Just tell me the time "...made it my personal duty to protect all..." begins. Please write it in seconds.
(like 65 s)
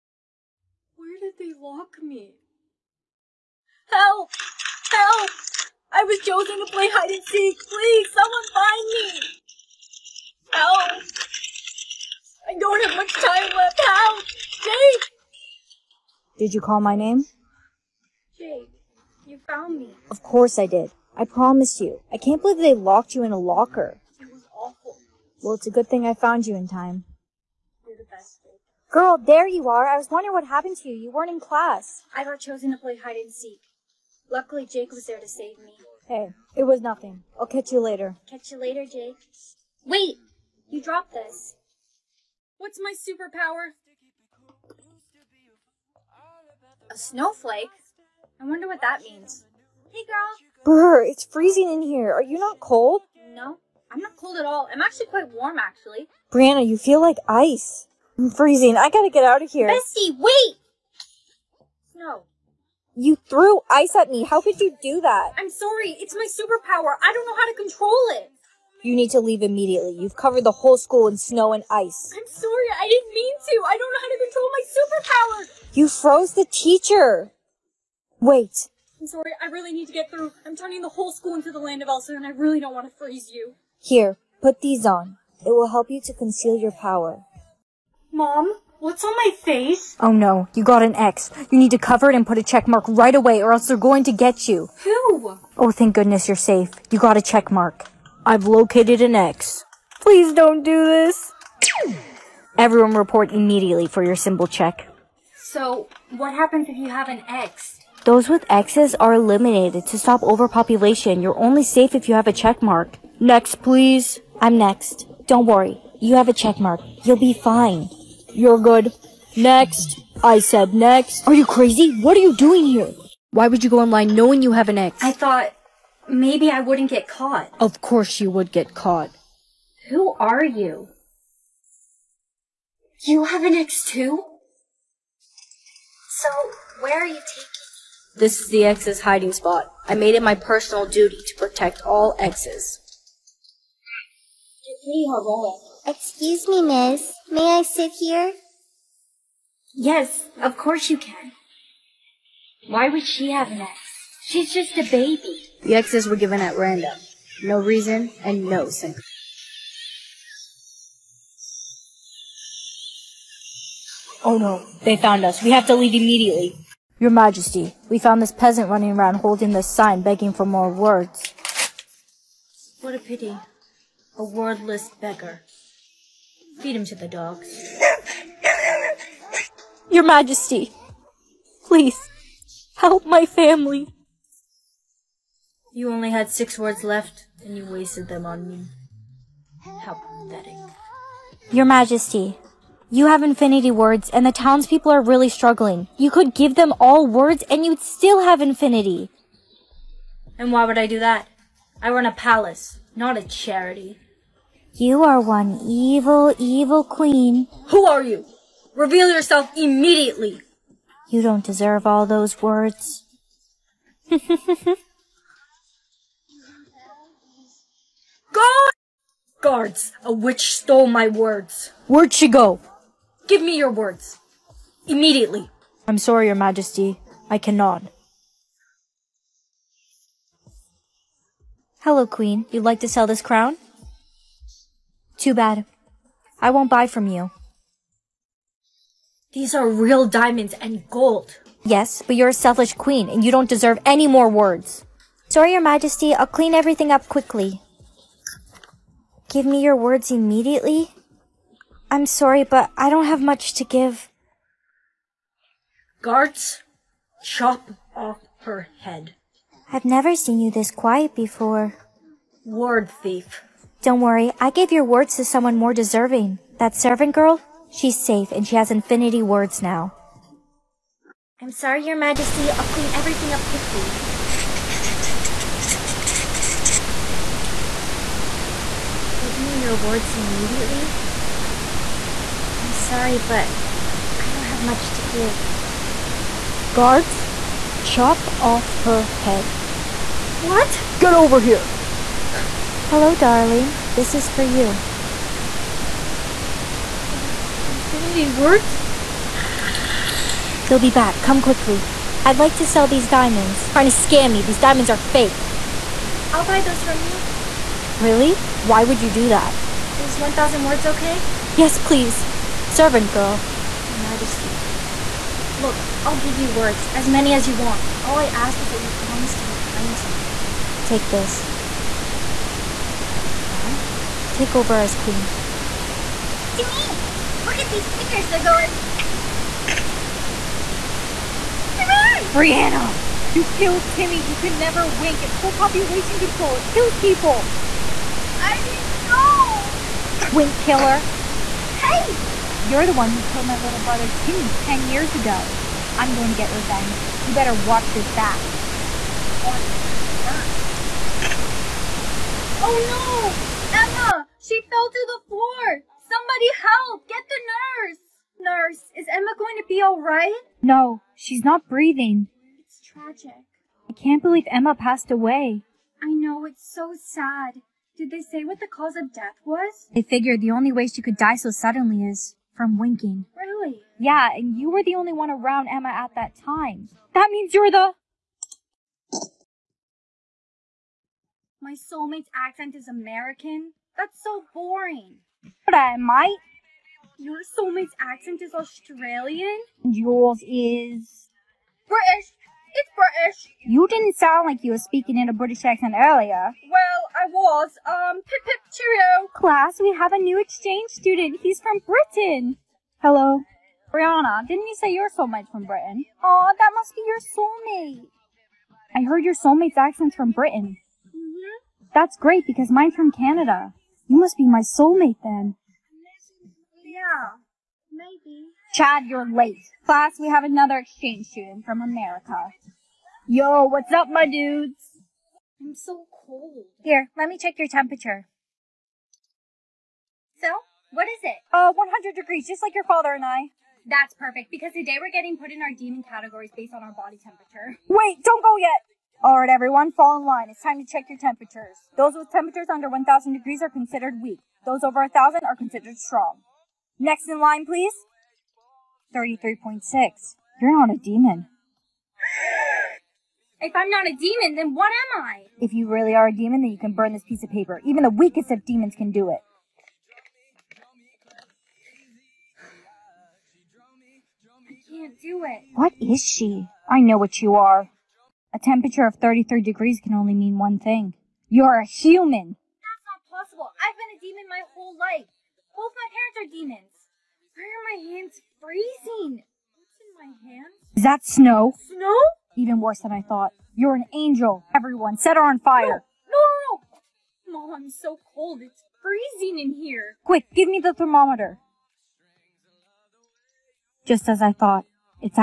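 139 s.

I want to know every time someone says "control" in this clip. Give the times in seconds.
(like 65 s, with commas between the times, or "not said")
67 s, 74 s, 336 s.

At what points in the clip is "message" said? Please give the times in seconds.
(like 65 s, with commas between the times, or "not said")
not said.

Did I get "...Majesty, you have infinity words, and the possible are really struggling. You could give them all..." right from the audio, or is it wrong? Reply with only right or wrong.
wrong.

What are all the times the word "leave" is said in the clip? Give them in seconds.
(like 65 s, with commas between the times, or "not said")
69 s, 165 s.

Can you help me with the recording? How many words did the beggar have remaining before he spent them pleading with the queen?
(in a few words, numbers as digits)
6.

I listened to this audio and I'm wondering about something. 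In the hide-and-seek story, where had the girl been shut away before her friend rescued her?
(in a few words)
A locker.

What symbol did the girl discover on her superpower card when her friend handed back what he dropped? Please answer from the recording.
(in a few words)
A snowflake.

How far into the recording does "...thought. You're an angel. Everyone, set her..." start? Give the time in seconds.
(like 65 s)
483 s.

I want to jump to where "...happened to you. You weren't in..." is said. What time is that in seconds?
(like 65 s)
30 s.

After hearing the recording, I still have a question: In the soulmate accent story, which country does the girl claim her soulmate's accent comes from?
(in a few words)
Canada.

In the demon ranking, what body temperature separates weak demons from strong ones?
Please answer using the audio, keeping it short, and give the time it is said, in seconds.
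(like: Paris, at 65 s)
1,000 degrees, at 442 s.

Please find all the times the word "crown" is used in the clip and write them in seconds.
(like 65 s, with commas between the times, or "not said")
233 s, 323 s.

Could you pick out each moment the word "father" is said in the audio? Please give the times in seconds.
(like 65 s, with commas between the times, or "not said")
432 s.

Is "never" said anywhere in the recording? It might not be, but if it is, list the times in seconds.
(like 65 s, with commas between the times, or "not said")
259 s, 334 s.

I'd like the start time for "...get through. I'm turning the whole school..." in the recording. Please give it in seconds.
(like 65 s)
79 s.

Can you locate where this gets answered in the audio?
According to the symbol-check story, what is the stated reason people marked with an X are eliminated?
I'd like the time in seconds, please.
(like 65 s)
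109 s.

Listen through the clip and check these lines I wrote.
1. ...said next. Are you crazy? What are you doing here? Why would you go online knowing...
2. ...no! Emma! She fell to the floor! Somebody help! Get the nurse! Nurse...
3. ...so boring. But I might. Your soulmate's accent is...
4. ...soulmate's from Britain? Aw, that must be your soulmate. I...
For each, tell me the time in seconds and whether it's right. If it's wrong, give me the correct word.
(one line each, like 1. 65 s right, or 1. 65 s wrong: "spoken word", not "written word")
1. 120 s right
2. 353 s right
3. 384 s right
4. 405 s right.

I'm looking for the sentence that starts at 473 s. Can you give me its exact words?
I've been a demon my whole life.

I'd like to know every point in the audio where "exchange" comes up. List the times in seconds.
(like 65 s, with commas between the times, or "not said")
400 s, 420 s.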